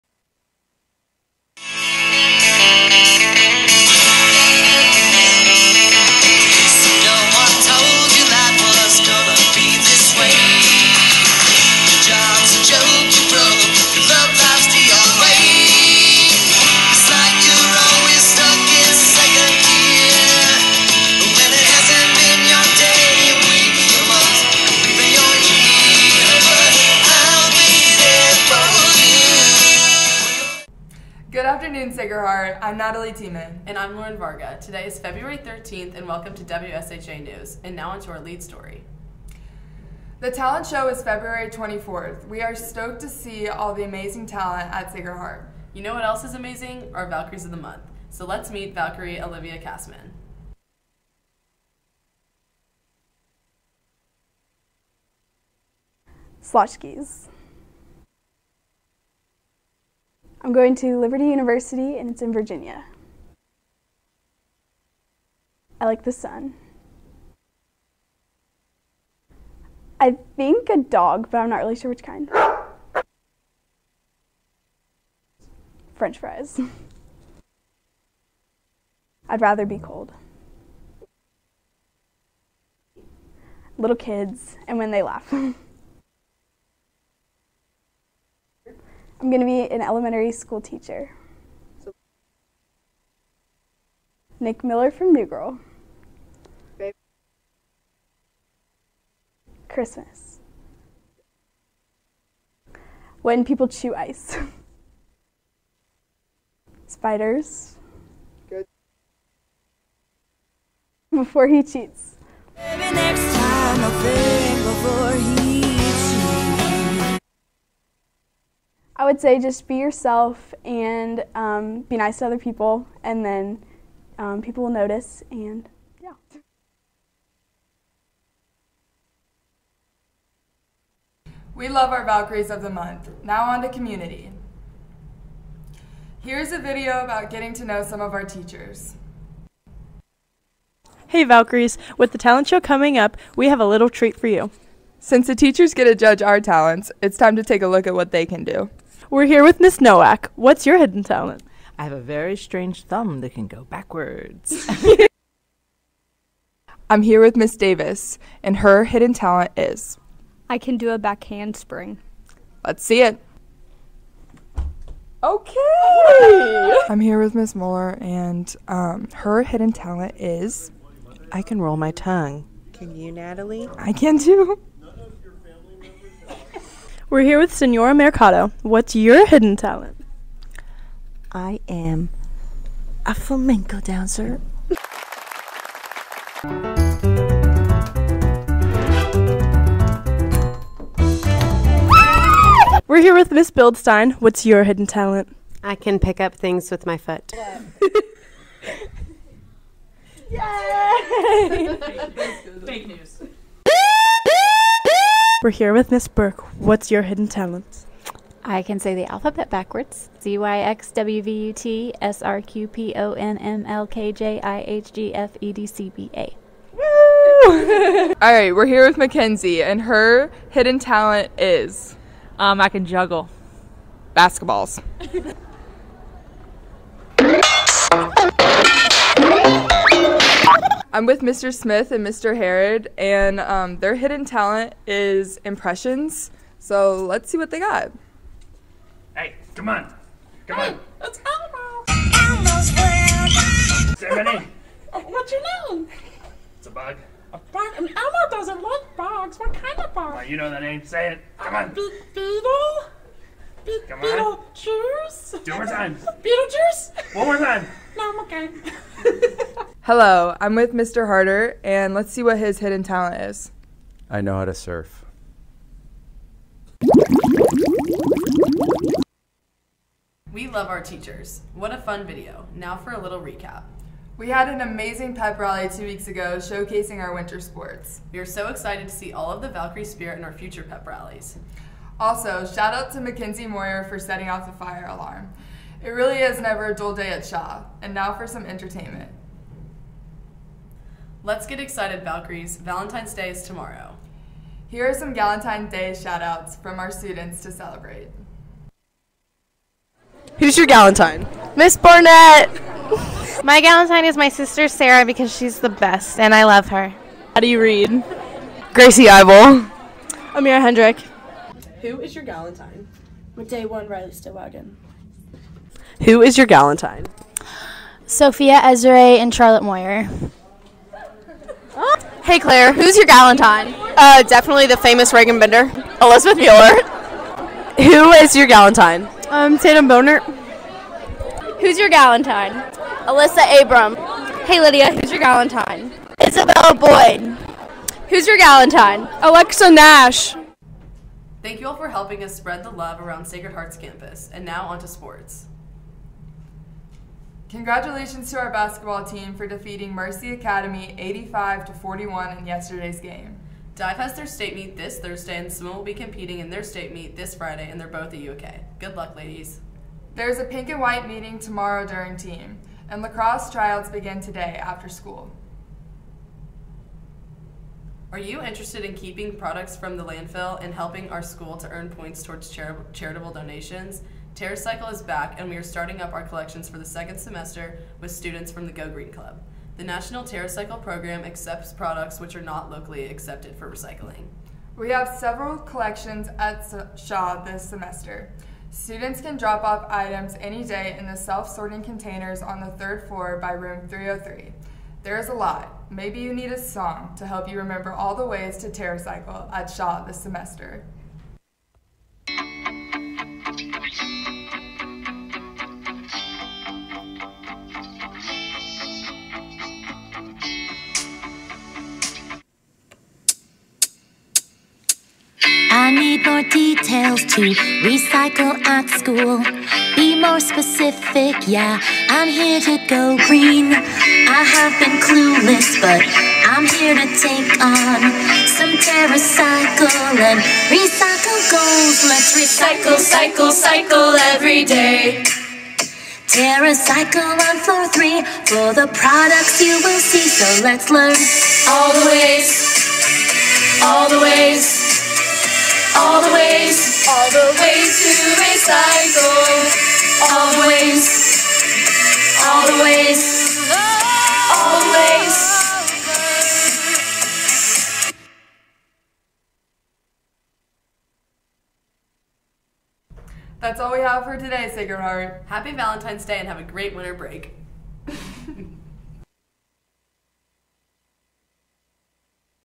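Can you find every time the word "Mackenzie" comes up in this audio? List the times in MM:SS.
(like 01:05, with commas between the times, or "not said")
03:38, 04:43.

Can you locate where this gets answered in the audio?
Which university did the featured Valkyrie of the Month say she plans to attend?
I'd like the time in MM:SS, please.
01:00.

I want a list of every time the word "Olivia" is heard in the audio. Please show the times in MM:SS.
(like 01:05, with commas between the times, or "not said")
00:49.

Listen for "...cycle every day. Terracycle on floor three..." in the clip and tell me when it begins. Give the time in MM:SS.
07:13.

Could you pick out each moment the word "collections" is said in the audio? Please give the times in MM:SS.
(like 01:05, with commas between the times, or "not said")
06:16, 06:25.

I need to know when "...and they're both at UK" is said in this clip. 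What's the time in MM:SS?
05:57.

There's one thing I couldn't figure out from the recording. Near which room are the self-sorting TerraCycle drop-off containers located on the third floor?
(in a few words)
Room 303.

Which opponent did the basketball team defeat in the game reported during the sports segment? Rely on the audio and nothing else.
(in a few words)
Mercy Academy.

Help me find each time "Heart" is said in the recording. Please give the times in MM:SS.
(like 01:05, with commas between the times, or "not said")
00:31, 00:44, 05:43, 07:45.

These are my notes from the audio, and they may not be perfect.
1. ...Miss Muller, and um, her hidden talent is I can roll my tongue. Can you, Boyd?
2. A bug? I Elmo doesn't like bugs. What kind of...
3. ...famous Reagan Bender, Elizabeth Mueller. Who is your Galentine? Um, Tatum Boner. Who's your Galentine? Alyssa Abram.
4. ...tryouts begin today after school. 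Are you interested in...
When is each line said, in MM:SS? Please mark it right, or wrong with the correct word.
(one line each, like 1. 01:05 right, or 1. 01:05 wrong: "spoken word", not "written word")
1. 02:47 wrong: "Natalie", not "Boyd"
2. 04:07 right
3. 05:24 right
4. 06:03 right.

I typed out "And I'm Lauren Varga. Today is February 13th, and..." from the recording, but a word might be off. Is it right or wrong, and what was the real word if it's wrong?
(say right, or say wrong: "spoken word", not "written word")
right.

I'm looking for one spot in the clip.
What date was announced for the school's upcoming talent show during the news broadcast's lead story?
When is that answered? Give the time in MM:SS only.
00:41.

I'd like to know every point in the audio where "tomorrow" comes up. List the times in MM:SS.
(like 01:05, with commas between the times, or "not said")
04:53, 06:01.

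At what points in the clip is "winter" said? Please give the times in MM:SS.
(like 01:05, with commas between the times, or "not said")
04:37, 07:46.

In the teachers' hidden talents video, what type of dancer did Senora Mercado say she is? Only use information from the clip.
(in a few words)
Flamenco.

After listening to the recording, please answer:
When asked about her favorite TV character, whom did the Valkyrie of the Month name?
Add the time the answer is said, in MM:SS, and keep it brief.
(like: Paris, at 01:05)
Nick Miller, at 01:34.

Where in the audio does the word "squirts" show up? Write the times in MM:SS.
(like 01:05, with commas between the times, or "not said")
not said.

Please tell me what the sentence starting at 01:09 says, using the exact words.
I think a dog, but I'm not really sure which kind.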